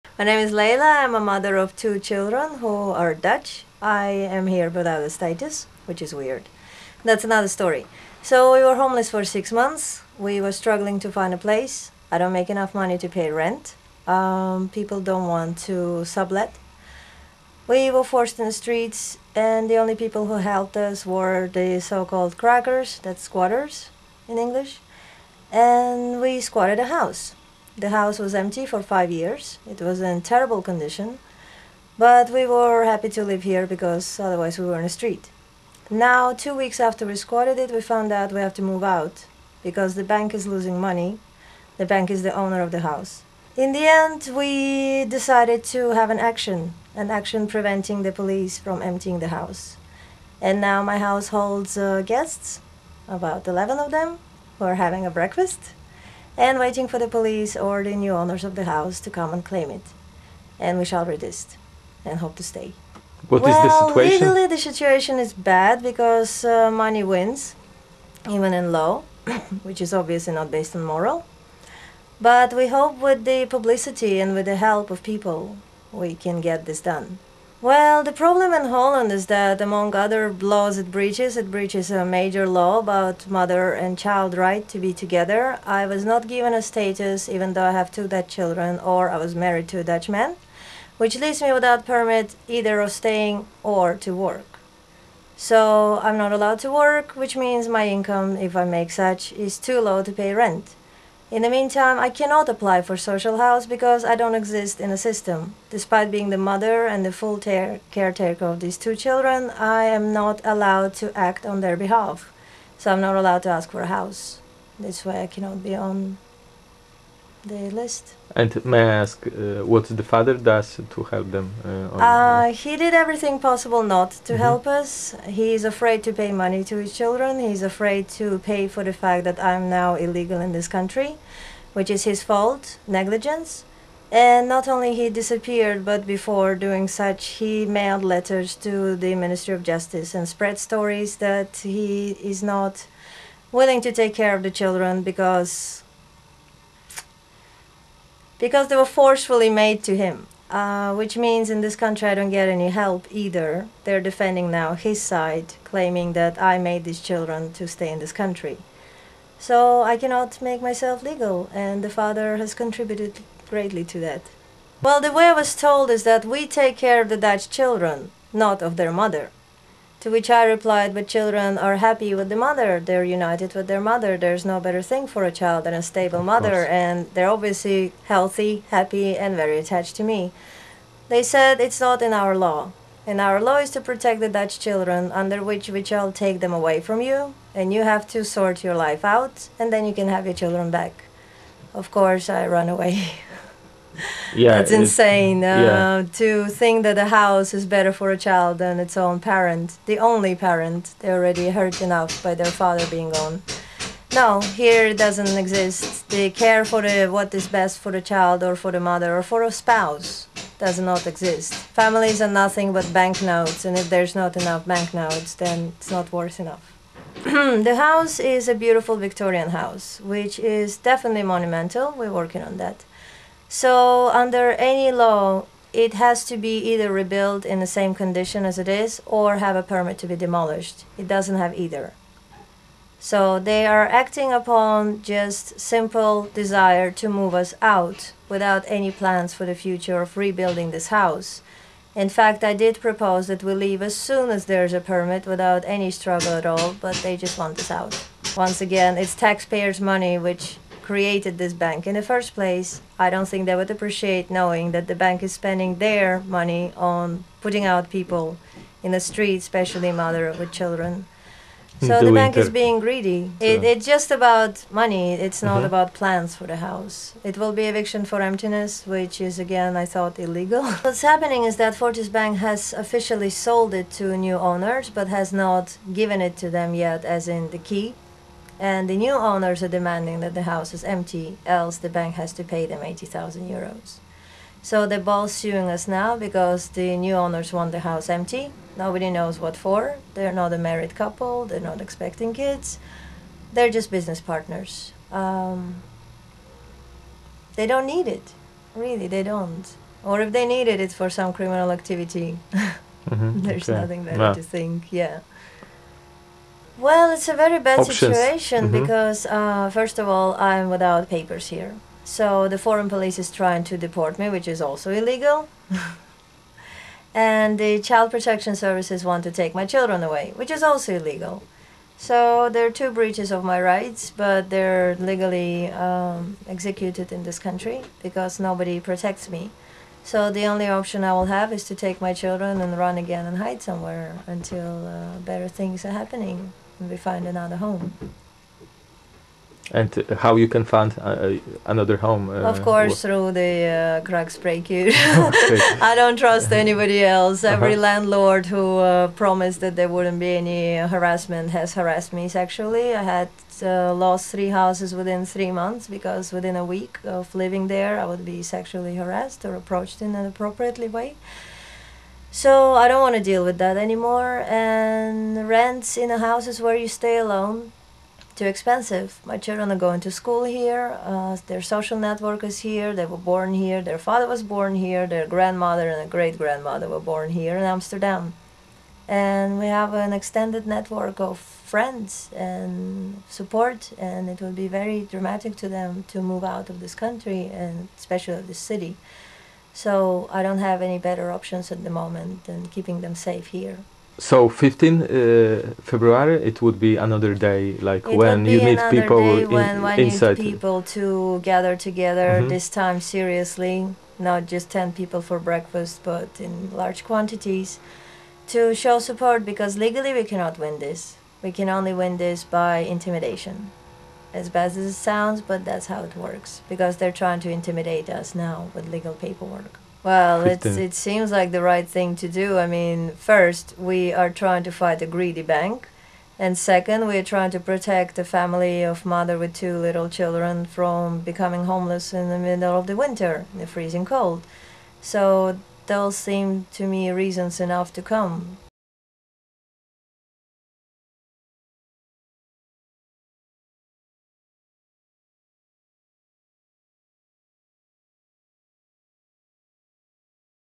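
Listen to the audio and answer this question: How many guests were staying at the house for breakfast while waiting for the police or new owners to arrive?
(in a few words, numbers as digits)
11.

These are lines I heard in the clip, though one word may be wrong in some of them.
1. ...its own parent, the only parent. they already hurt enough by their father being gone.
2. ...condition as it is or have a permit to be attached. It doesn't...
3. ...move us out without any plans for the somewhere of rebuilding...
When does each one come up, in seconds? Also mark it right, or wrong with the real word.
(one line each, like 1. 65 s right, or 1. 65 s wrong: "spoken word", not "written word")
1. 198 s right
2. 227 s wrong: "demolished", not "attached"
3. 237 s wrong: "future", not "somewhere".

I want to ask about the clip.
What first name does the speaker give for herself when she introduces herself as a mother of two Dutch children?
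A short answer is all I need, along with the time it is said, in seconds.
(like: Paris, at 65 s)
Leila, at 0 s.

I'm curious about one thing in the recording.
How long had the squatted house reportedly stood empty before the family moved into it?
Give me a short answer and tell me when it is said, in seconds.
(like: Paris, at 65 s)
5 years, at 28 s.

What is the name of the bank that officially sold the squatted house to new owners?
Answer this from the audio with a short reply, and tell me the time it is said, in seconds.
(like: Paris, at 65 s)
Fortis, at 271 s.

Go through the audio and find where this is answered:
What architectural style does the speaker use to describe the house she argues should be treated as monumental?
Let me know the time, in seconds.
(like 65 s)
218 s.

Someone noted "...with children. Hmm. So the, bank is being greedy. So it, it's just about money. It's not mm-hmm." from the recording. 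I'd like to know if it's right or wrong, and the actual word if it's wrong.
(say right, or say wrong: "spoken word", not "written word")
right.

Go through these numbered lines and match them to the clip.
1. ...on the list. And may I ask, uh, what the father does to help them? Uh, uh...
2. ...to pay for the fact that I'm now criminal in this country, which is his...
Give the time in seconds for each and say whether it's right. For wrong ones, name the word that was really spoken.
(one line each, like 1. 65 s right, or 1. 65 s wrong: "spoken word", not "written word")
1. 115 s right
2. 128 s wrong: "illegal", not "criminal".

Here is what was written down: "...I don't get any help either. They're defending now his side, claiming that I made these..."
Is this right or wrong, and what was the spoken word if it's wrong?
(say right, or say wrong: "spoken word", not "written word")
right.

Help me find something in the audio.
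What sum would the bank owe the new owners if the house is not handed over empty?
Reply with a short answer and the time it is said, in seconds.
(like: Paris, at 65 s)
80,000 euros, at 282 s.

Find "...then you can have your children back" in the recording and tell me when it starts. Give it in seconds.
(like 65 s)
189 s.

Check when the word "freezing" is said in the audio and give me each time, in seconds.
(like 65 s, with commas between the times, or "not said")
433 s.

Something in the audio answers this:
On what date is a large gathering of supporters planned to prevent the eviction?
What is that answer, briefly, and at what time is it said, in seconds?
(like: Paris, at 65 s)
15 February, at 394 s.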